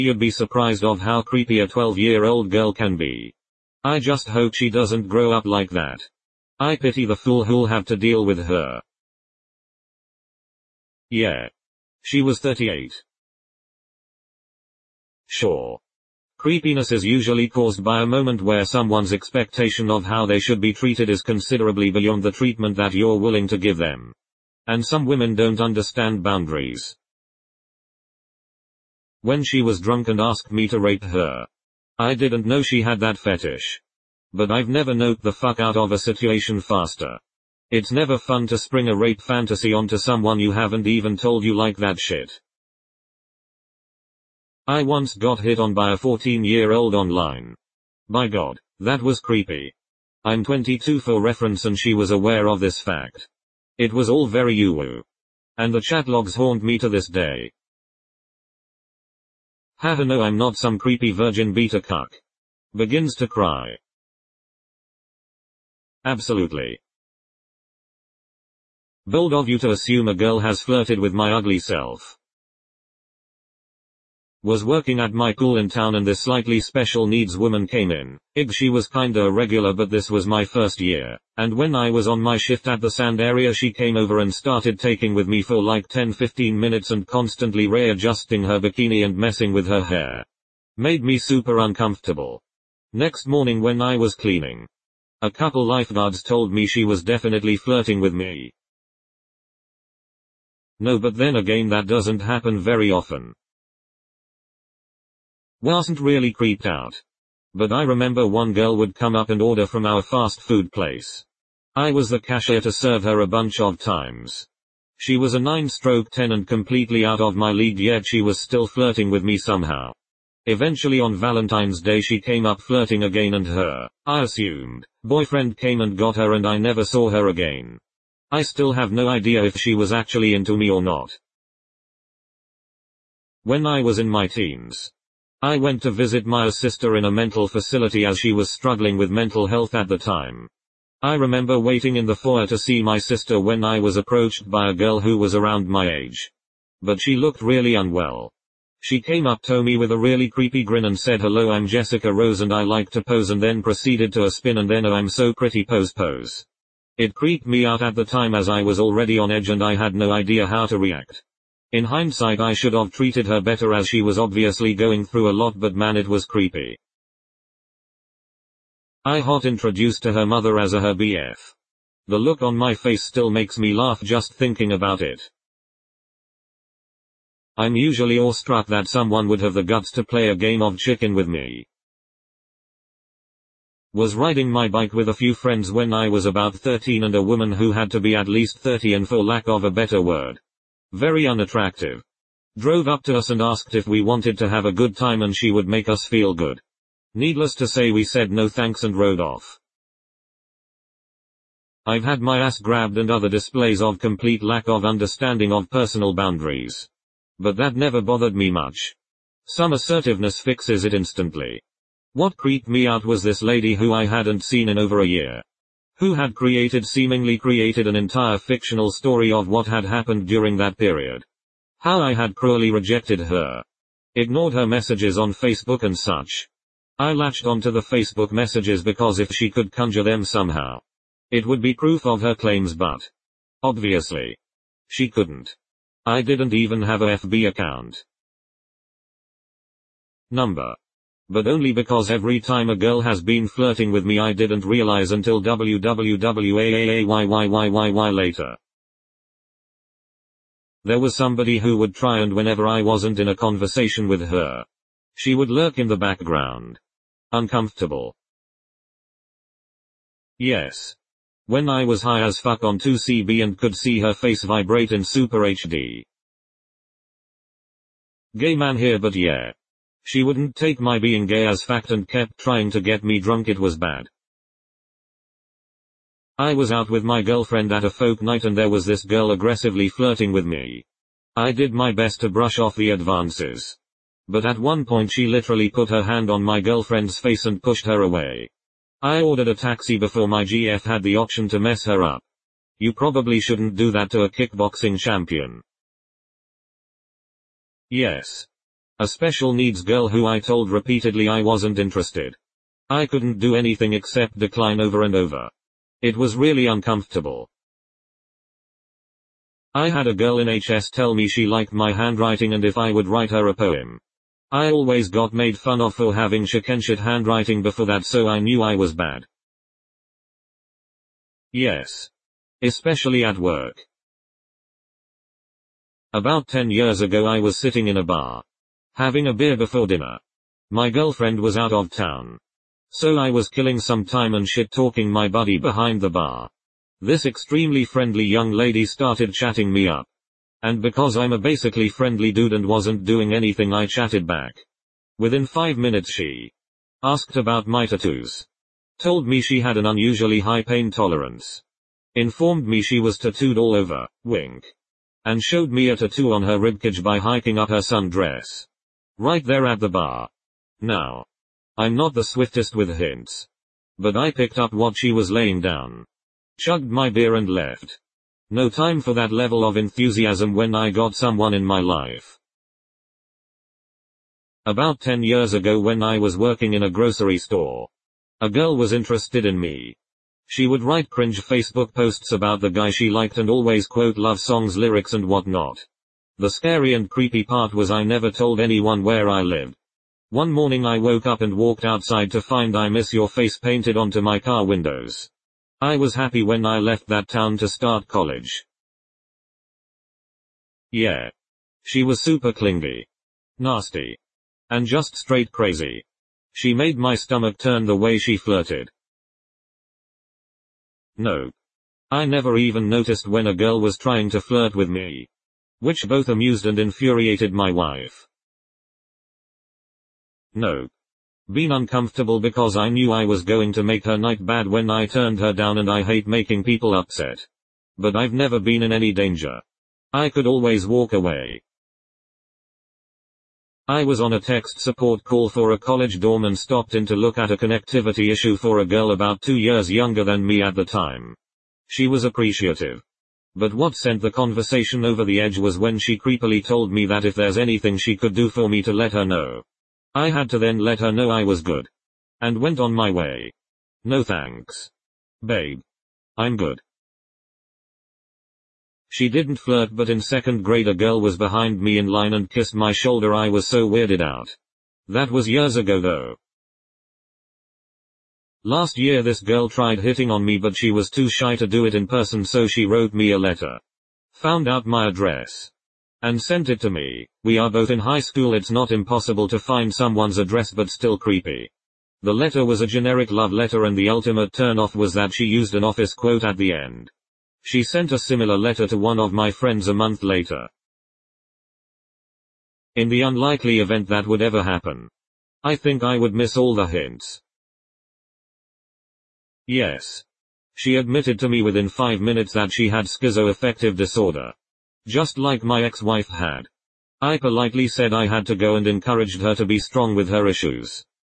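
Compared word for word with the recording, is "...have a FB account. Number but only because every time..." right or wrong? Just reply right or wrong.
right.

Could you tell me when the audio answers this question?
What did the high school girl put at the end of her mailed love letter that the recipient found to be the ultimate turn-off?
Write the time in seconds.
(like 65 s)
485 s.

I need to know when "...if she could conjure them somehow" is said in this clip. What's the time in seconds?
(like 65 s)
229 s.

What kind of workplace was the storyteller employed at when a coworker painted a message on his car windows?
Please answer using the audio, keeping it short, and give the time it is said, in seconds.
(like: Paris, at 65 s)
grocery store, at 376 s.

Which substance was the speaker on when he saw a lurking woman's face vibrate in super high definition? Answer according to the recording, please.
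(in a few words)
2CB.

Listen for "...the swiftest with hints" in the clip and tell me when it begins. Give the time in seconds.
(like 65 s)
362 s.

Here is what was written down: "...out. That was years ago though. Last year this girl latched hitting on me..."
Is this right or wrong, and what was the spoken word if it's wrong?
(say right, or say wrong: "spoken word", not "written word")
wrong: "tried", not "latched".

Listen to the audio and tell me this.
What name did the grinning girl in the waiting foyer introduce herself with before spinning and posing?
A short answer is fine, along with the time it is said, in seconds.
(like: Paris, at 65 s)
Jessica Rose, at 151 s.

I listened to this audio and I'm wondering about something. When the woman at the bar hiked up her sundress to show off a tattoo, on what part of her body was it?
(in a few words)
ribcage.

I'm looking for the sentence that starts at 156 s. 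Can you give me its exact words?
It creeped me out at the time as I was already on edge and I had no idea how to react.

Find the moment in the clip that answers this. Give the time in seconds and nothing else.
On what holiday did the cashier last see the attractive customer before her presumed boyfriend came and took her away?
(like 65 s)
121 s.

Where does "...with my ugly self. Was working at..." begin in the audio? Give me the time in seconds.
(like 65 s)
70 s.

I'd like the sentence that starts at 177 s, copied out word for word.
I'm usually awestruck that someone would have the guts to play a game of chicken with me.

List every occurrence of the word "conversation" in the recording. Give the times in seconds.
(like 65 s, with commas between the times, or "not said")
253 s, 444 s.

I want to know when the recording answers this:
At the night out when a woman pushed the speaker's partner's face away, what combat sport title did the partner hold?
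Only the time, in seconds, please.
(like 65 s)
294 s.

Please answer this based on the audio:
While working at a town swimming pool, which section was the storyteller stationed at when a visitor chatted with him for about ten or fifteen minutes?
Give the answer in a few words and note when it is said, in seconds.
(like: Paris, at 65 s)
sand area, at 82 s.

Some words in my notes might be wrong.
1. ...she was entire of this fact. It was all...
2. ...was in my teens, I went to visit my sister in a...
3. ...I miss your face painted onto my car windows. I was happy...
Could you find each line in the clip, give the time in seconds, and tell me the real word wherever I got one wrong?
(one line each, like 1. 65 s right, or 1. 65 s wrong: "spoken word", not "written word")
1. 51 s wrong: "aware", not "entire"
2. 133 s right
3. 392 s right.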